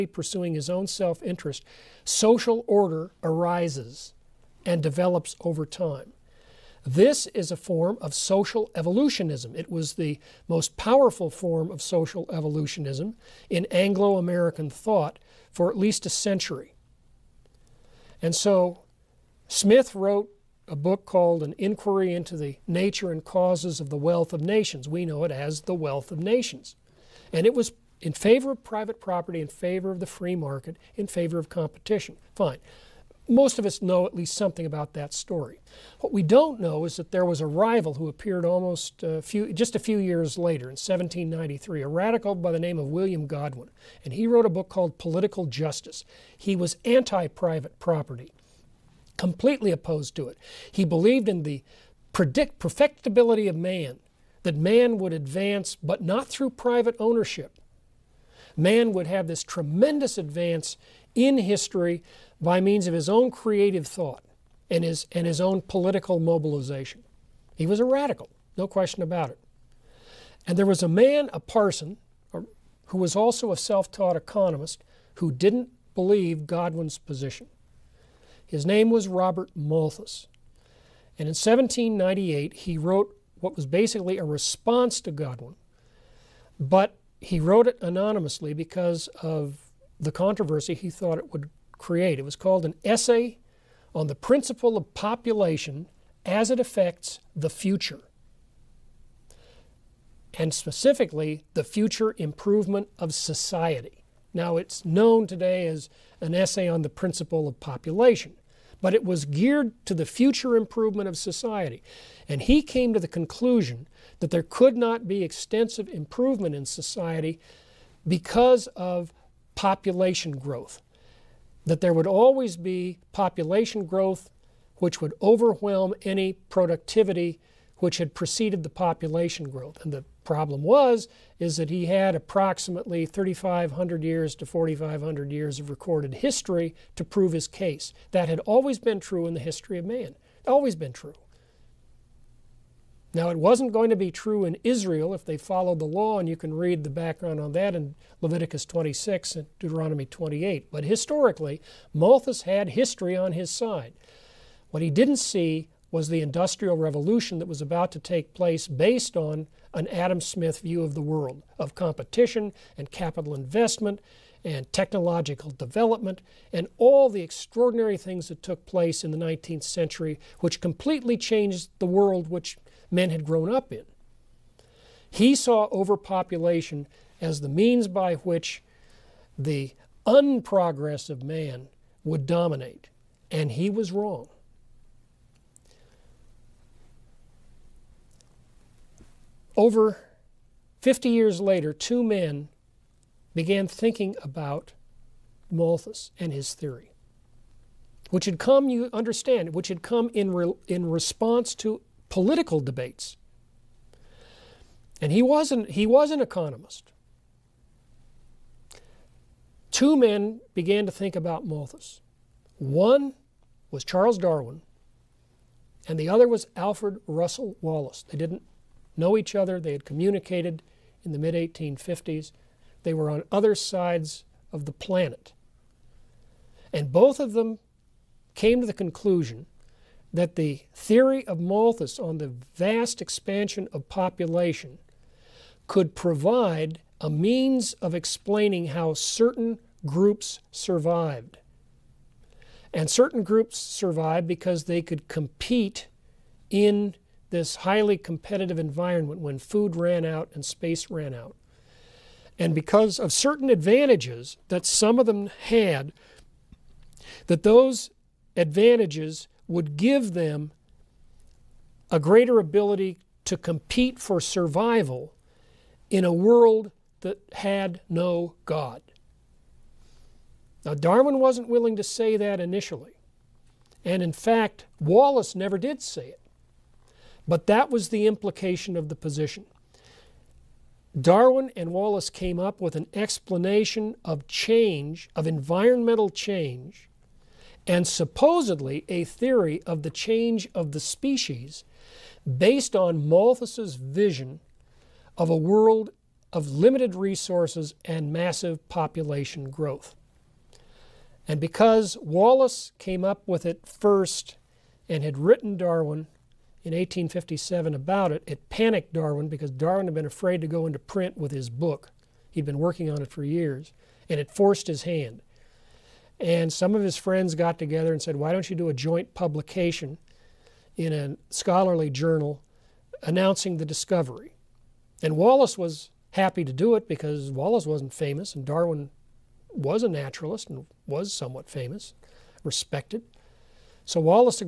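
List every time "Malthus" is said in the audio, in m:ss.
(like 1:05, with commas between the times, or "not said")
1:19, 2:31, 3:15, 3:31, 3:51, 4:53.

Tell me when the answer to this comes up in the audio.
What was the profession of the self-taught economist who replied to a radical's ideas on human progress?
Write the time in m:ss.
1:11.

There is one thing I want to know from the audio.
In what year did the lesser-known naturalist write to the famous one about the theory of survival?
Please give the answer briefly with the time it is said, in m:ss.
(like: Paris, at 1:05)
1857, at 5:06.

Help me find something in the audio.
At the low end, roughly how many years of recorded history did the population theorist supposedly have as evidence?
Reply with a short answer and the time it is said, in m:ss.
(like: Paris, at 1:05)
3,500, at 2:13.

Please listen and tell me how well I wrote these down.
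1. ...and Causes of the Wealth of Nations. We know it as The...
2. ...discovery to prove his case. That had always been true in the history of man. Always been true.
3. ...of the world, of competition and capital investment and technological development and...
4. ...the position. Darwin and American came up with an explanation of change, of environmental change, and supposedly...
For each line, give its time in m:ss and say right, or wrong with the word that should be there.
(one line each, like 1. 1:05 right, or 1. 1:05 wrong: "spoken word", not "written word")
1. 0:23 right
2. 2:16 wrong: "history", not "discovery"
3. 2:40 right
4. 4:38 wrong: "Wallace", not "American".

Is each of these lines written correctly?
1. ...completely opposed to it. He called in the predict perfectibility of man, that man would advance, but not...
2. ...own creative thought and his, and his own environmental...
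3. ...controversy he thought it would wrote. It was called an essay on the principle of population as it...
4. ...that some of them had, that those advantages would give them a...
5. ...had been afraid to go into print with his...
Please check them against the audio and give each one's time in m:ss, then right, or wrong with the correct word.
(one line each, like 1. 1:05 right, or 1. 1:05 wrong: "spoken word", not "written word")
1. 0:49 wrong: "believed", not "called"
2. 1:03 wrong: "political", not "environmental"
3. 1:30 wrong: "create", not "wrote"
4. 4:14 right
5. 5:09 right.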